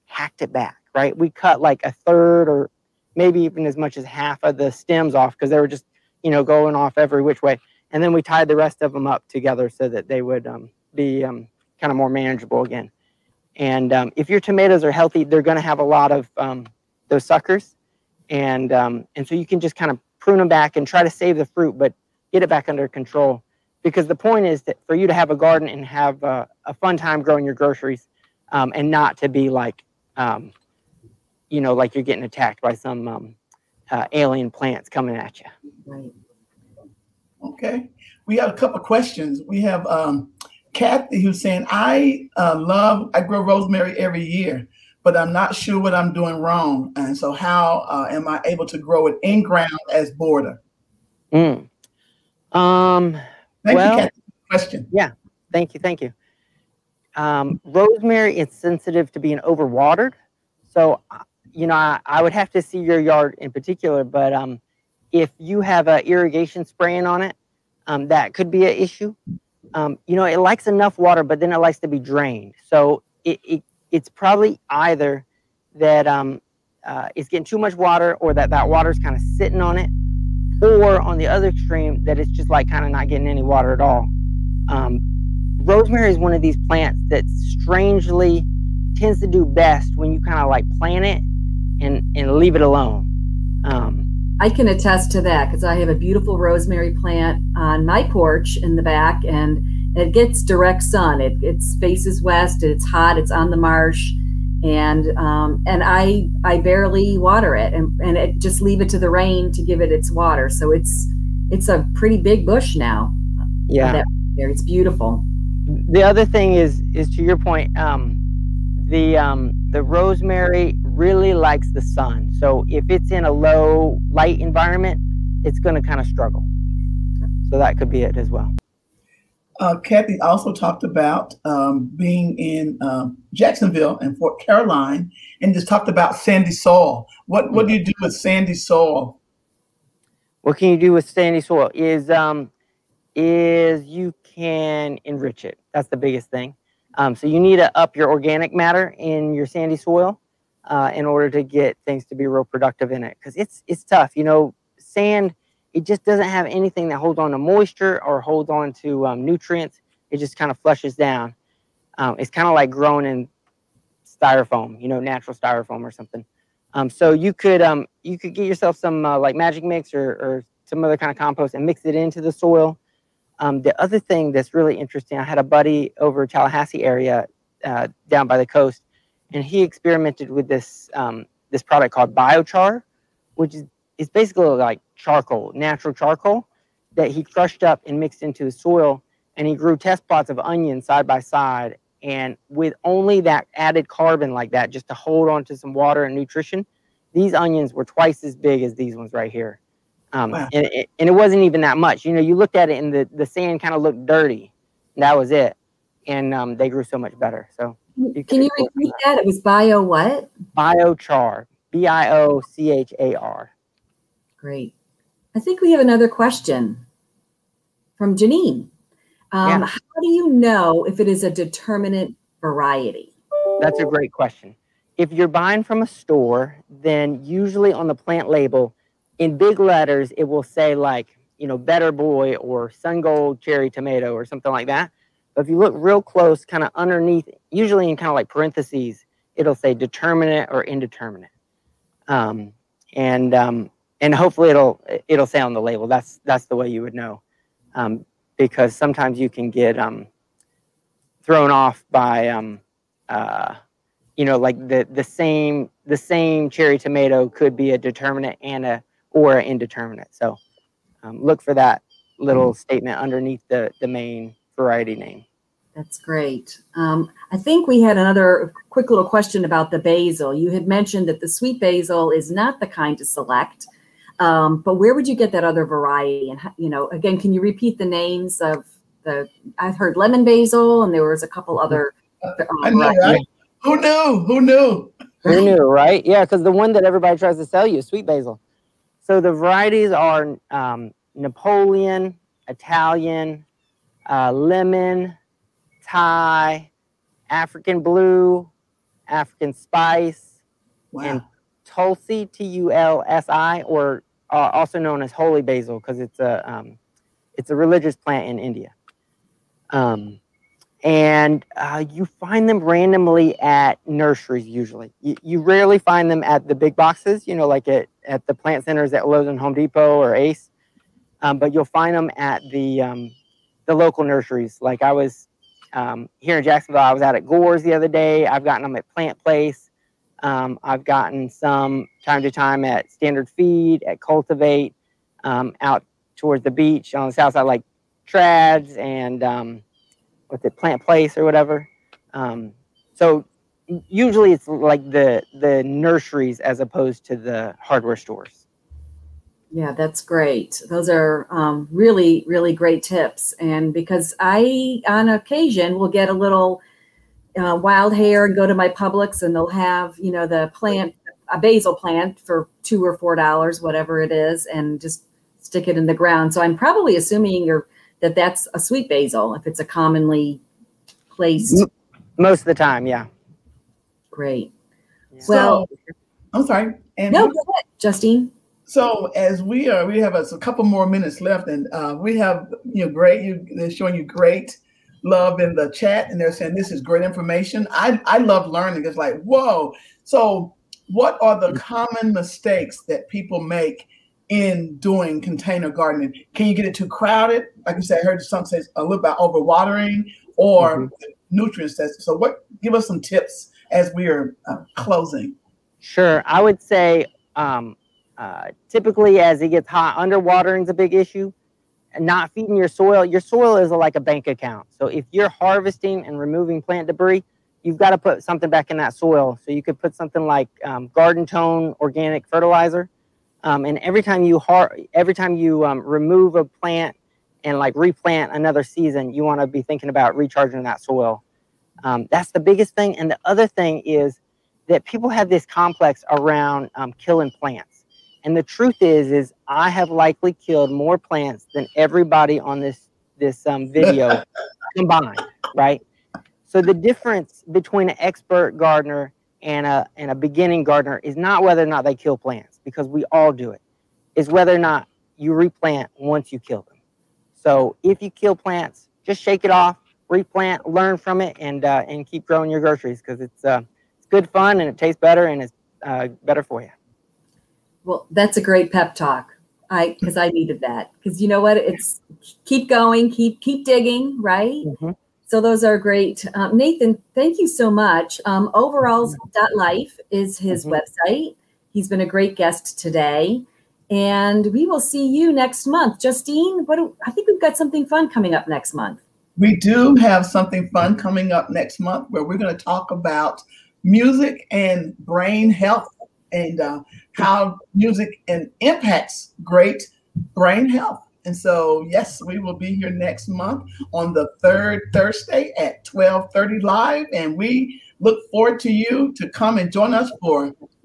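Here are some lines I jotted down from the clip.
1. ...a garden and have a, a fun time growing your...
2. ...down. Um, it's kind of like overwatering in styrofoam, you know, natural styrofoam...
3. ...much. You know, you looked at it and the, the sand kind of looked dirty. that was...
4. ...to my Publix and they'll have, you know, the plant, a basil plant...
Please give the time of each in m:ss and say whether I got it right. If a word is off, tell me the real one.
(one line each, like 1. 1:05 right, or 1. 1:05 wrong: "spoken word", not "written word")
1. 0:25 right
2. 2:40 wrong: "growing", not "overwatering"
3. 3:21 right
4. 5:58 right.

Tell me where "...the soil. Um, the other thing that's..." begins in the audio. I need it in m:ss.
2:52.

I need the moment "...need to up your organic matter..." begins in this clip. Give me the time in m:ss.
2:27.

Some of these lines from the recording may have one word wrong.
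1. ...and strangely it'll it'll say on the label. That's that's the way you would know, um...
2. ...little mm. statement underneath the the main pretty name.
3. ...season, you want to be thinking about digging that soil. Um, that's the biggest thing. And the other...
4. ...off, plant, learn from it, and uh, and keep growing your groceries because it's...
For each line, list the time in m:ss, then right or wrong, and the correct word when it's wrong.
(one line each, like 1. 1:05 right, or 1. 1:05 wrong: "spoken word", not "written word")
1. 4:03 wrong: "hopefully", not "strangely"
2. 4:22 wrong: "variety", not "pretty"
3. 7:08 wrong: "recharging", not "digging"
4. 7:39 wrong: "replant", not "plant".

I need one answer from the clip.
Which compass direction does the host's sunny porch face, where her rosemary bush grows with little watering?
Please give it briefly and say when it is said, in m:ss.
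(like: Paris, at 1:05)
west, at 1:42.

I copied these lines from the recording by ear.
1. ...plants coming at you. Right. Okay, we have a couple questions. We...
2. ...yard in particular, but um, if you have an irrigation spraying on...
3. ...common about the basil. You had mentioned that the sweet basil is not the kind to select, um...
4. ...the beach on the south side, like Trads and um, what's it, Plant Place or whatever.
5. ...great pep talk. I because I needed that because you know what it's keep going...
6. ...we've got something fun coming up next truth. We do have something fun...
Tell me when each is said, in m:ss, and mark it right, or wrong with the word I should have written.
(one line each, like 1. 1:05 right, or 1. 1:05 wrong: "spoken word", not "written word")
1. 0:34 right
2. 1:02 right
3. 4:29 wrong: "question", not "common"
4. 5:36 right
5. 7:48 right
6. 8:07 wrong: "month", not "truth".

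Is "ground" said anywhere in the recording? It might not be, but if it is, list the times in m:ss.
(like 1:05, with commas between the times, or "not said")
0:49, 6:05.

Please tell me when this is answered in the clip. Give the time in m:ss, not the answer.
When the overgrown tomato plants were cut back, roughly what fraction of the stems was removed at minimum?
0:01.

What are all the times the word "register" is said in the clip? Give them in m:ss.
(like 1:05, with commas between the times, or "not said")
not said.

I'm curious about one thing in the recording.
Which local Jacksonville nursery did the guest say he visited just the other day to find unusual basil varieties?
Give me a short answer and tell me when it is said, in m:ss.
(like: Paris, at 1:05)
Gore's, at 5:27.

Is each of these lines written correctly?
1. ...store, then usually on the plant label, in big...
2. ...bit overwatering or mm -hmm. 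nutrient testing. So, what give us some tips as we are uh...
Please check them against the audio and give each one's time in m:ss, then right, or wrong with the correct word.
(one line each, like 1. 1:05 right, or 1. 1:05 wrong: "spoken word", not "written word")
1. 3:45 right
2. 6:39 right.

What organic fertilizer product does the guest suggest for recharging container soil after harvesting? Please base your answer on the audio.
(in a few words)
Garden Tone.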